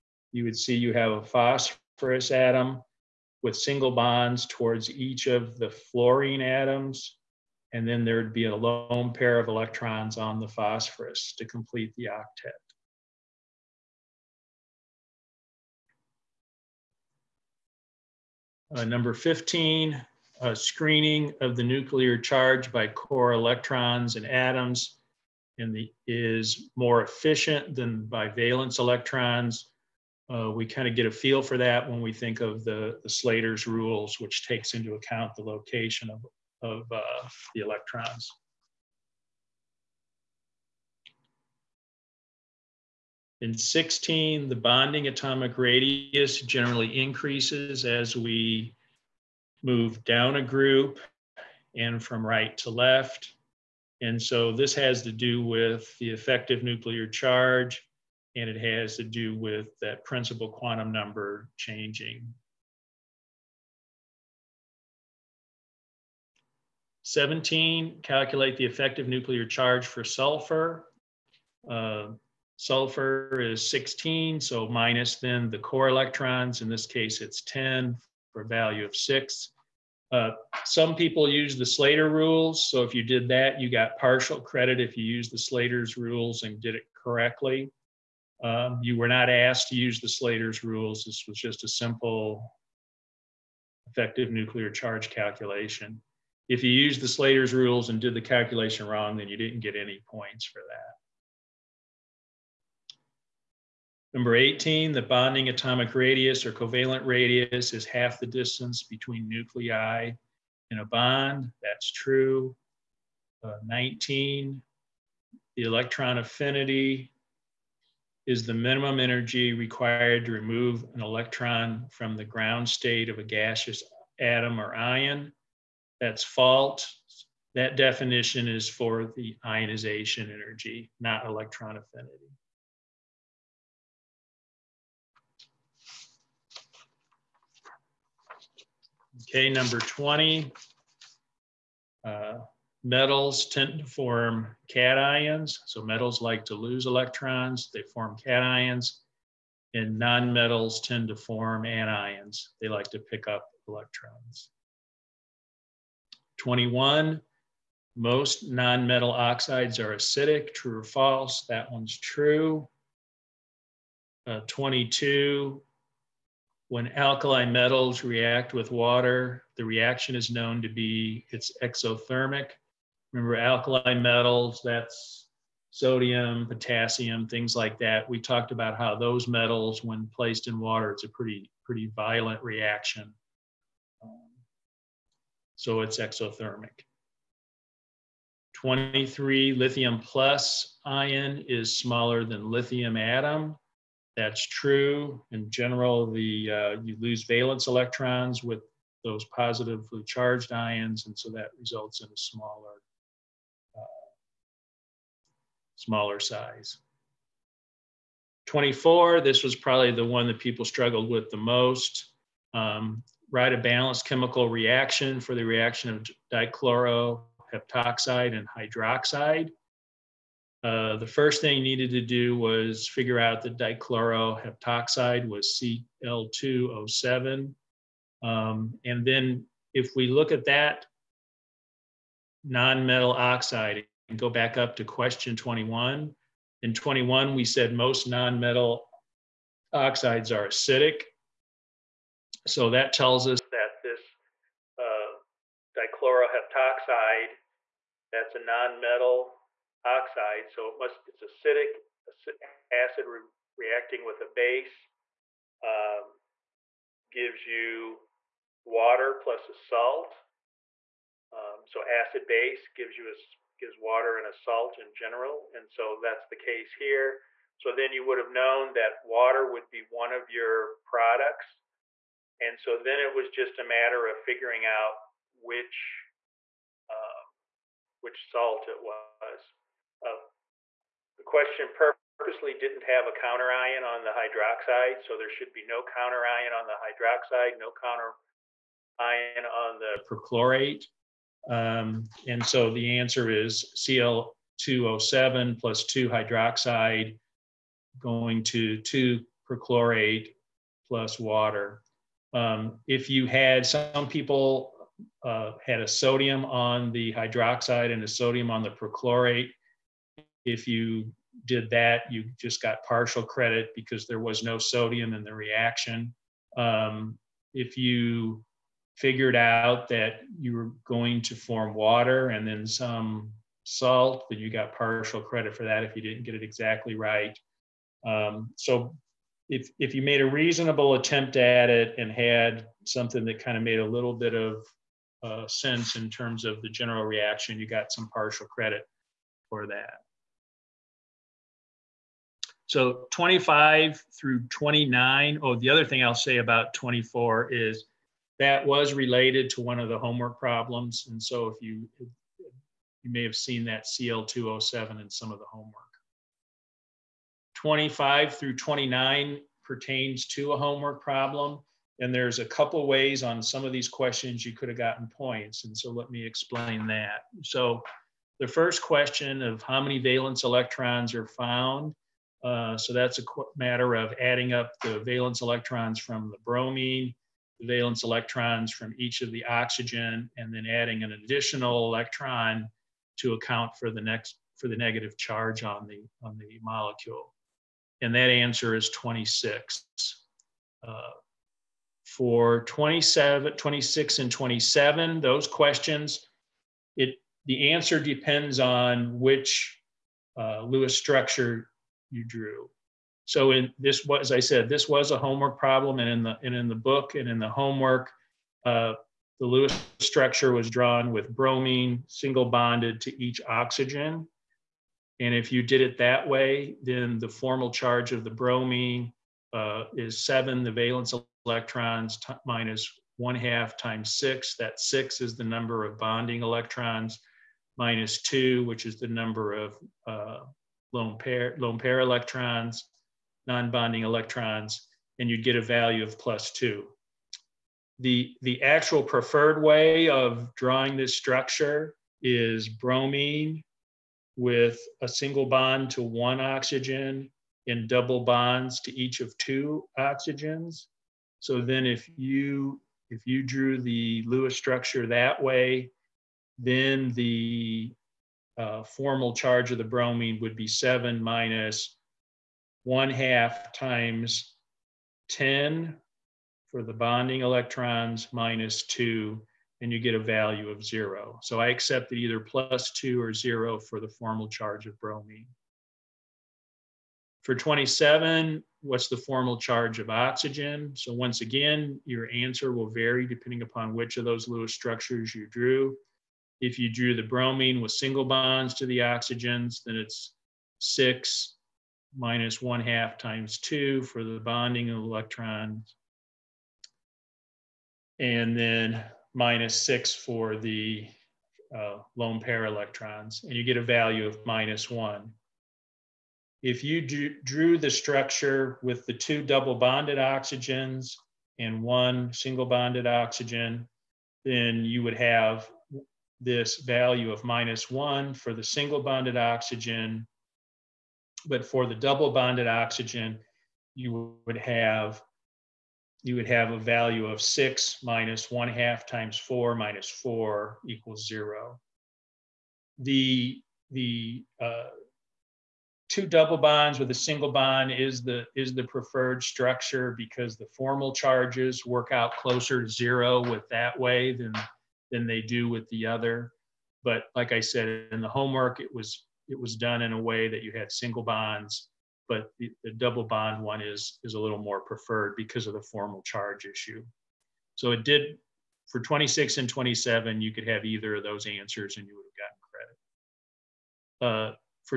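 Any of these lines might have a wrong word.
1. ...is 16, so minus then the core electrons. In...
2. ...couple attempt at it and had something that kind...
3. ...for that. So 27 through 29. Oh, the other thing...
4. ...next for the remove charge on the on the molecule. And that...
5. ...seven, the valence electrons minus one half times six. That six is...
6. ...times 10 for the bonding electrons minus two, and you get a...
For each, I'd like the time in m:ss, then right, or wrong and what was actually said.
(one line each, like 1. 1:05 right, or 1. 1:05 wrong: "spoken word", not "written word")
1. 1:13 right
2. 5:30 wrong: "reasonable", not "couple"
3. 5:39 wrong: "25", not "27"
4. 6:24 wrong: "negative", not "remove"
5. 7:00 right
6. 7:43 right.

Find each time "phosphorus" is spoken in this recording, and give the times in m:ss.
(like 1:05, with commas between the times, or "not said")
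0:01, 0:10.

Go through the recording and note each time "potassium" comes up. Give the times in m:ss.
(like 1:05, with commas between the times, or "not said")
2:56.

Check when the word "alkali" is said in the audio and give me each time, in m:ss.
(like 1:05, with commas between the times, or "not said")
2:46, 2:53.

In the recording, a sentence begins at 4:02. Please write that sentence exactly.
So that tells us that this uh, dichloroheptoxide, that's a nonmetal oxide.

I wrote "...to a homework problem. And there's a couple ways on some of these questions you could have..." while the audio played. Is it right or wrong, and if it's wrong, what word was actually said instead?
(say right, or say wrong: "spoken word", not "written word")
right.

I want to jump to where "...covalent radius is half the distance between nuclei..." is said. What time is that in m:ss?
1:46.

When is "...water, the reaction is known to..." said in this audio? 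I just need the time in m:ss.
2:48.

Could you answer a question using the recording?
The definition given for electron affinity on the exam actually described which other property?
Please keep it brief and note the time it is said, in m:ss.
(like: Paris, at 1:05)
ionization energy, at 2:09.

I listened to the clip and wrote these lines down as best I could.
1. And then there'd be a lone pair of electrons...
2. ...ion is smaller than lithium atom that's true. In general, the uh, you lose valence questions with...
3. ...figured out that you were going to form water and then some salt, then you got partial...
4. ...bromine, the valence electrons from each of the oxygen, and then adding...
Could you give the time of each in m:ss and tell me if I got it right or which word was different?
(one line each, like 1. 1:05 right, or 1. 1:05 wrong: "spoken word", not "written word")
1. 0:07 right
2. 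3:10 wrong: "electrons", not "questions"
3. 5:18 right
4. 6:16 right.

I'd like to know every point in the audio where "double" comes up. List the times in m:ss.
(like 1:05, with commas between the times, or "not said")
7:27, 8:29, 8:41, 8:56, 9:12.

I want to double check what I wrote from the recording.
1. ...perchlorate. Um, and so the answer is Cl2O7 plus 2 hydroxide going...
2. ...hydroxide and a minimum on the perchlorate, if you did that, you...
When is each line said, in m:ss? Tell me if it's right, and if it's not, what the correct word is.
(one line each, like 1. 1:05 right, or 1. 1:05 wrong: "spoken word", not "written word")
1. 4:50 right
2. 5:07 wrong: "sodium", not "minimum".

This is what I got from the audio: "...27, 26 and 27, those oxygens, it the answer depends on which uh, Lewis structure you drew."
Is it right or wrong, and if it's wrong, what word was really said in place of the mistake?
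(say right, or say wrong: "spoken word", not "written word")
wrong: "questions", not "oxygens".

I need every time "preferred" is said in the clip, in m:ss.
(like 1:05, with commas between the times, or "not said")
7:19, 8:58, 9:14.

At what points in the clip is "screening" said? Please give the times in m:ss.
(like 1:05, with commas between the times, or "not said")
0:20.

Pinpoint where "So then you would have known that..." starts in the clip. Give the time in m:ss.
4:27.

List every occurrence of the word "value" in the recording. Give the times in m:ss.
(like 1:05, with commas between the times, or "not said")
1:18, 7:15, 7:50, 8:23, 8:36, 8:46.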